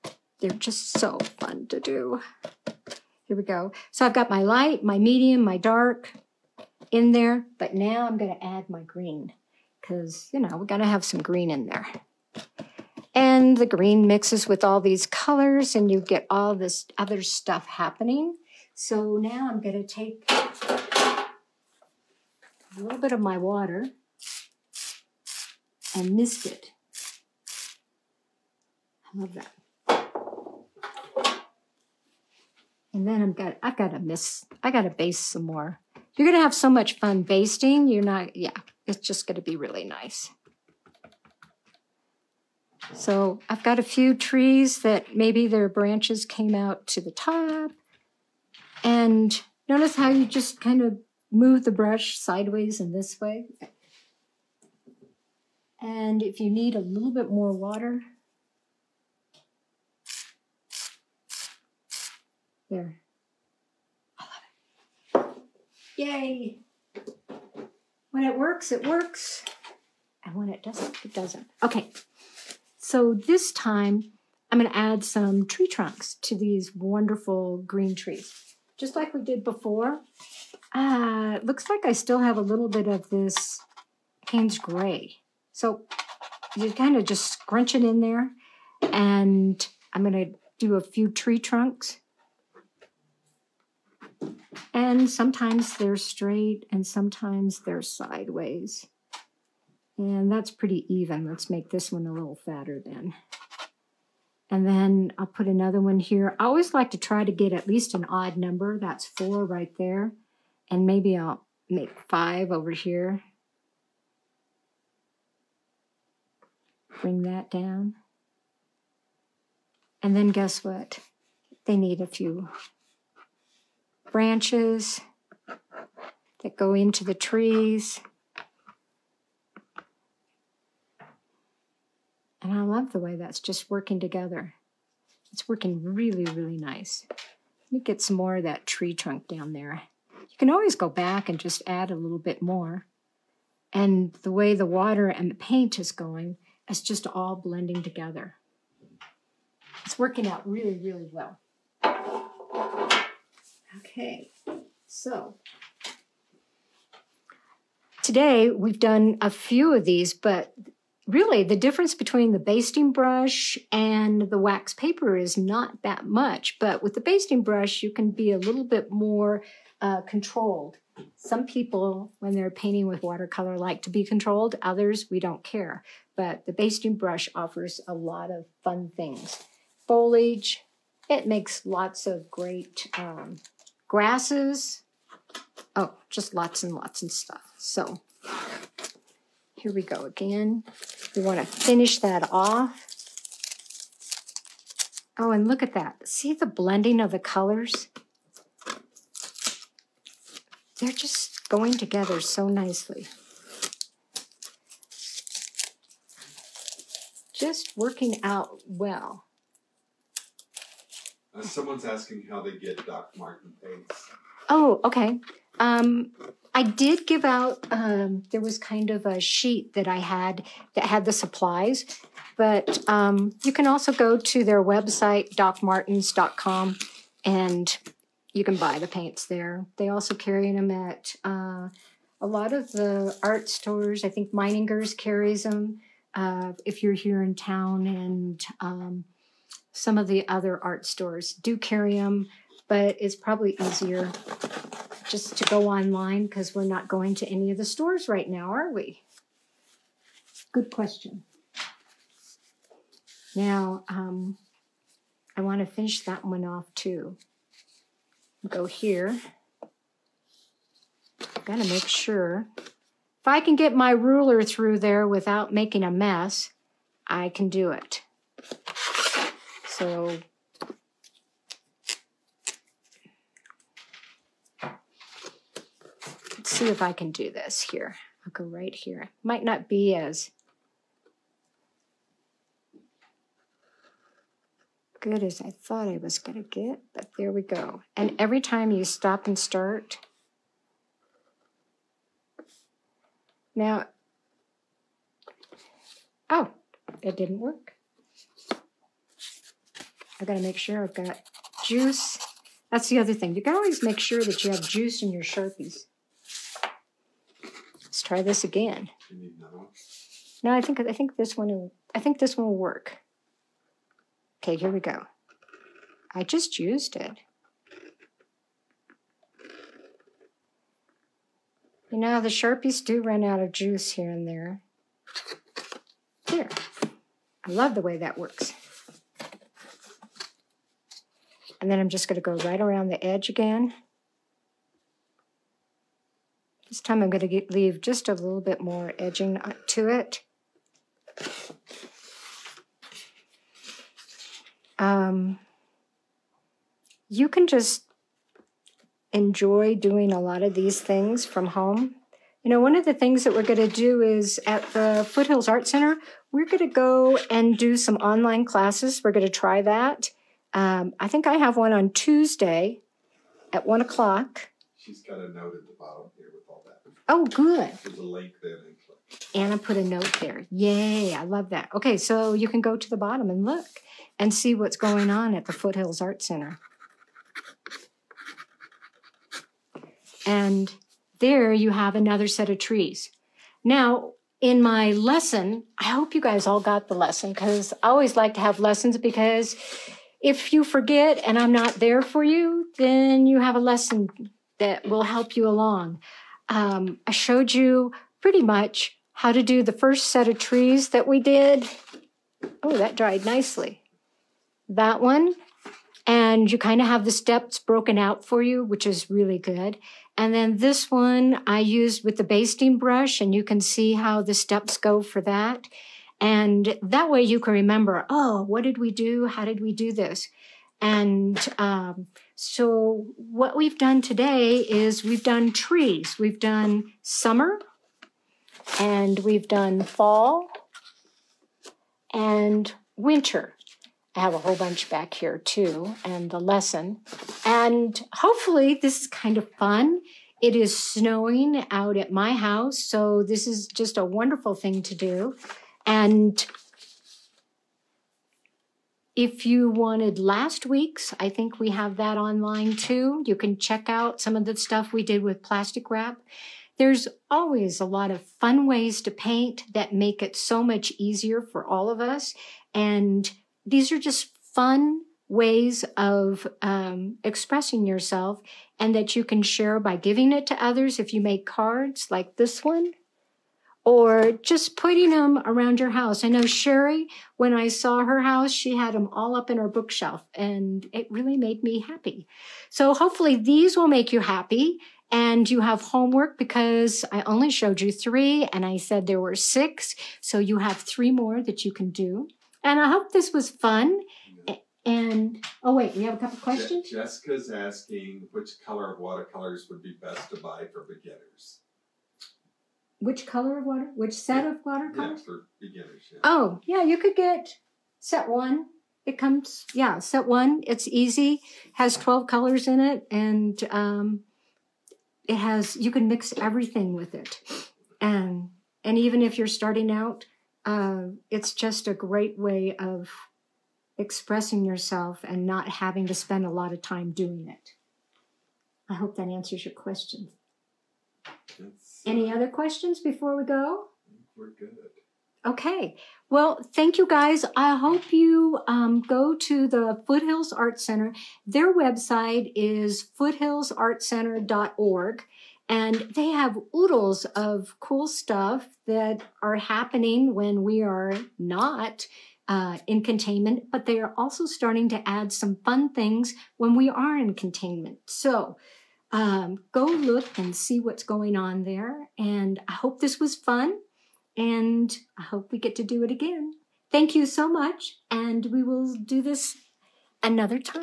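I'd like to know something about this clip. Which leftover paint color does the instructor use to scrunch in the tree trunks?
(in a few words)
Payne's Gray.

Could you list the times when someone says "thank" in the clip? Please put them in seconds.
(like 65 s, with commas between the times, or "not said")
536 s, 566 s.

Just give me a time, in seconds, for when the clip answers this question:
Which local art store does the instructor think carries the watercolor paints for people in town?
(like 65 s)
234 s.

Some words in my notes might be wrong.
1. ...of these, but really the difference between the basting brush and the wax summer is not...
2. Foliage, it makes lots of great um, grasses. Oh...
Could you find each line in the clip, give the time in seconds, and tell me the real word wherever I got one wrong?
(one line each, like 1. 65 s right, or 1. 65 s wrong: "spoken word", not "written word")
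1. 159 s wrong: "paper", not "summer"
2. 179 s right.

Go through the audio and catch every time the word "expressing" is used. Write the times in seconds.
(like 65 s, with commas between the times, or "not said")
467 s, 523 s.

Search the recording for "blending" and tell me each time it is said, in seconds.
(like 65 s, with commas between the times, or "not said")
147 s, 196 s.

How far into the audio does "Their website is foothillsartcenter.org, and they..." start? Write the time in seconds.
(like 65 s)
541 s.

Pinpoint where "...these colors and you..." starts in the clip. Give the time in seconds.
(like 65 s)
14 s.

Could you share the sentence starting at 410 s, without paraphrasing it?
And then this one I used with the basting brush, and you can see how the steps go for that.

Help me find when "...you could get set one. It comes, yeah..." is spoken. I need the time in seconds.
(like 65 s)
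506 s.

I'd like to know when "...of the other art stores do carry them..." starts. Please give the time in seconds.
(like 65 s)
239 s.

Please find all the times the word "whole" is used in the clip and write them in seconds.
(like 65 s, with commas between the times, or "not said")
434 s.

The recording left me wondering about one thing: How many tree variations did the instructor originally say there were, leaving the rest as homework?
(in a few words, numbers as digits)
6.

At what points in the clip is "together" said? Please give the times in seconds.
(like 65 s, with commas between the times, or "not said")
133 s, 147 s, 201 s.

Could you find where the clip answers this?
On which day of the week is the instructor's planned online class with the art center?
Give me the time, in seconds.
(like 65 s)
361 s.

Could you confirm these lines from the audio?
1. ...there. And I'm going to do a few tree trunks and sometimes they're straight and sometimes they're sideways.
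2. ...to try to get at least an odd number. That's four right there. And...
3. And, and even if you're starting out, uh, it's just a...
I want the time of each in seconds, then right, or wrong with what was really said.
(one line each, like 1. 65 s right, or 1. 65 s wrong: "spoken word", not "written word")
1. 88 s right
2. 106 s right
3. 518 s right.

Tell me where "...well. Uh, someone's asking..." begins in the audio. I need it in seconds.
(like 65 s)
208 s.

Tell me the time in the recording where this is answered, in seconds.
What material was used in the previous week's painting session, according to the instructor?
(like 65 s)
455 s.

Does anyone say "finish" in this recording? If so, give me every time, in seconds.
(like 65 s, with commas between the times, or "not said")
191 s, 255 s.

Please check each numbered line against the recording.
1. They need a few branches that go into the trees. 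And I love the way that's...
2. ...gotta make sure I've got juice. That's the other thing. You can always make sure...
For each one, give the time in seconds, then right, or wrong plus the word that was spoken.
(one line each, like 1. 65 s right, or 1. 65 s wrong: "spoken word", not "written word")
1. 121 s right
2. 300 s right.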